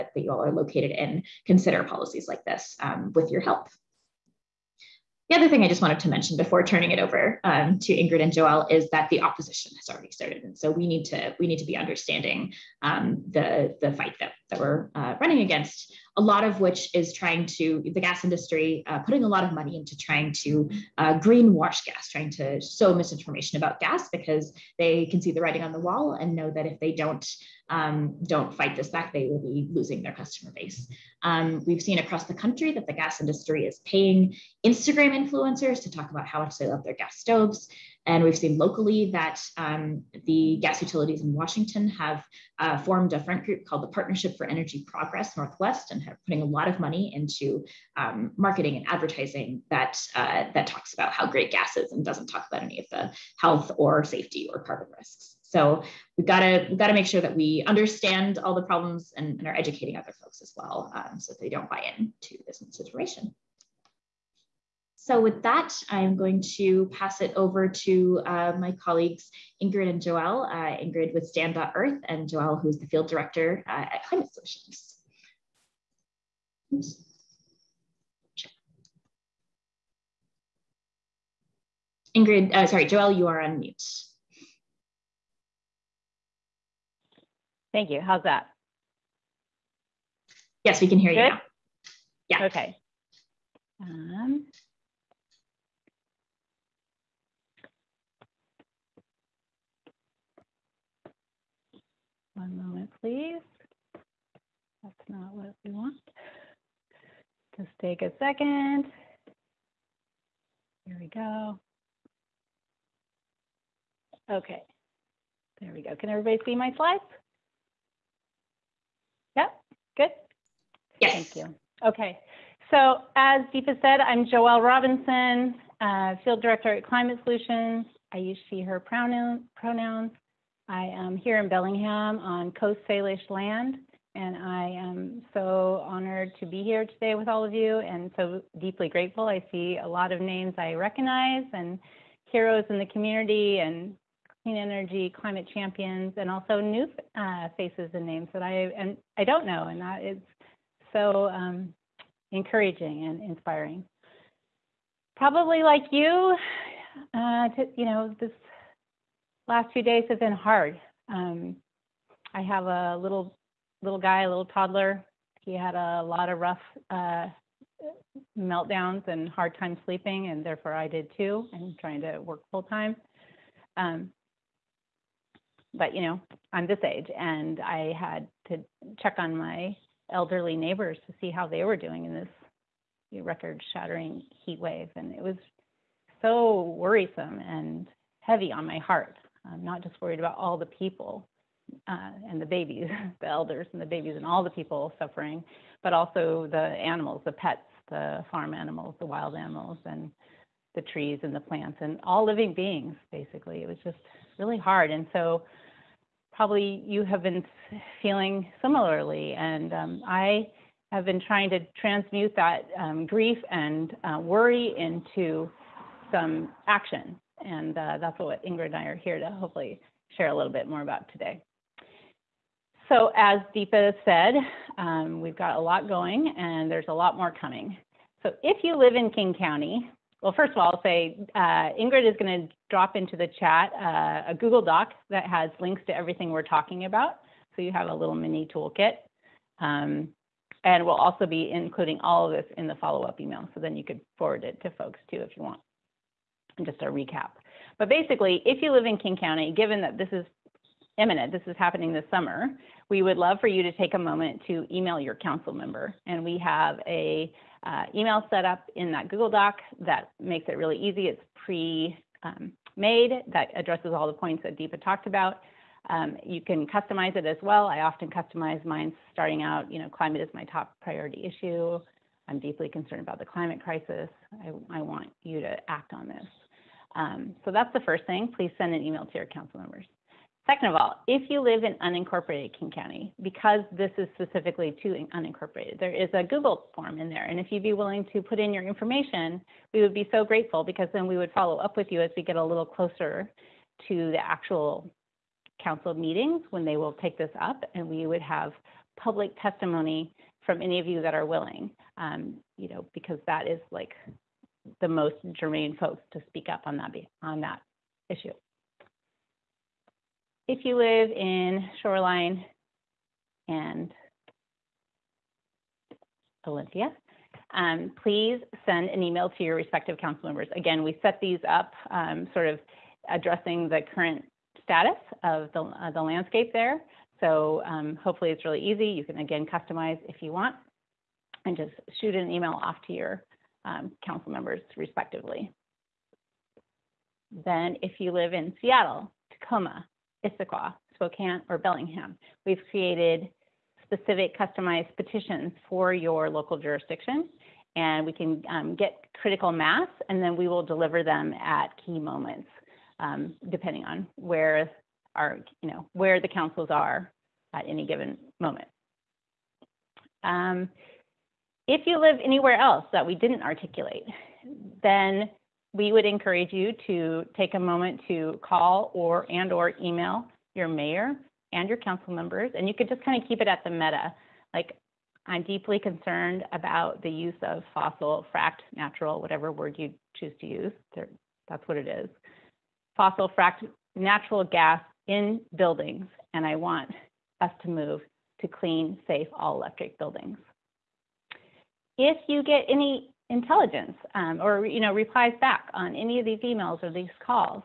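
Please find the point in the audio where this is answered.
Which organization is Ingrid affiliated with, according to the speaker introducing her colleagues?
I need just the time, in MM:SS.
01:11.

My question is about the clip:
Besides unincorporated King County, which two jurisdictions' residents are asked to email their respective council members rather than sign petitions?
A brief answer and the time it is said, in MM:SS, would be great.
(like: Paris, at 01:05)
Shoreline and Olympia, at 05:11.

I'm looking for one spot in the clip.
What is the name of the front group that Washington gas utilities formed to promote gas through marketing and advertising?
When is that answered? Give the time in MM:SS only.
00:43.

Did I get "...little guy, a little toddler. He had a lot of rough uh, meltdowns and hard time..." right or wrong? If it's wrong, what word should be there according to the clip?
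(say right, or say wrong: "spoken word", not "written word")
right.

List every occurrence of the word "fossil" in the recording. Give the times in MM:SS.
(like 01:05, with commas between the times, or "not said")
06:17, 06:22.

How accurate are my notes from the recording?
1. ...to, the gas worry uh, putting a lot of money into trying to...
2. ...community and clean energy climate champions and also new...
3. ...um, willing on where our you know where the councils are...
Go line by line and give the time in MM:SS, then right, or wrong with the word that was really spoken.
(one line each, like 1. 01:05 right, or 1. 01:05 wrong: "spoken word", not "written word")
1. 00:17 wrong: "industry", not "worry"
2. 02:22 right
3. 05:52 wrong: "depending", not "willing".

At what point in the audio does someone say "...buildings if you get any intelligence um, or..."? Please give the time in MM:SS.
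06:29.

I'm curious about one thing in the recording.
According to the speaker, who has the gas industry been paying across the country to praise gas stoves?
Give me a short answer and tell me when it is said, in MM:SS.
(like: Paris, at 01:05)
Instagram influencers, at 00:34.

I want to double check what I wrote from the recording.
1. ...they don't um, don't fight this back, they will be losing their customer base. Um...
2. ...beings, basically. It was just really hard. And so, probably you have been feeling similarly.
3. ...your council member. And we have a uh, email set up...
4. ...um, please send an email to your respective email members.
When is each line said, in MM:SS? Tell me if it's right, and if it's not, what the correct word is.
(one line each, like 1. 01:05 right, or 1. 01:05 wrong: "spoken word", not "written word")
1. 00:26 right
2. 03:22 right
3. 04:15 right
4. 05:17 wrong: "council", not "email".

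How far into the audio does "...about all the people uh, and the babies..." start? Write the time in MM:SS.
03:10.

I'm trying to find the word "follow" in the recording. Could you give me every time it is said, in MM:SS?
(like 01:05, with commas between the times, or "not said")
04:02, 04:51.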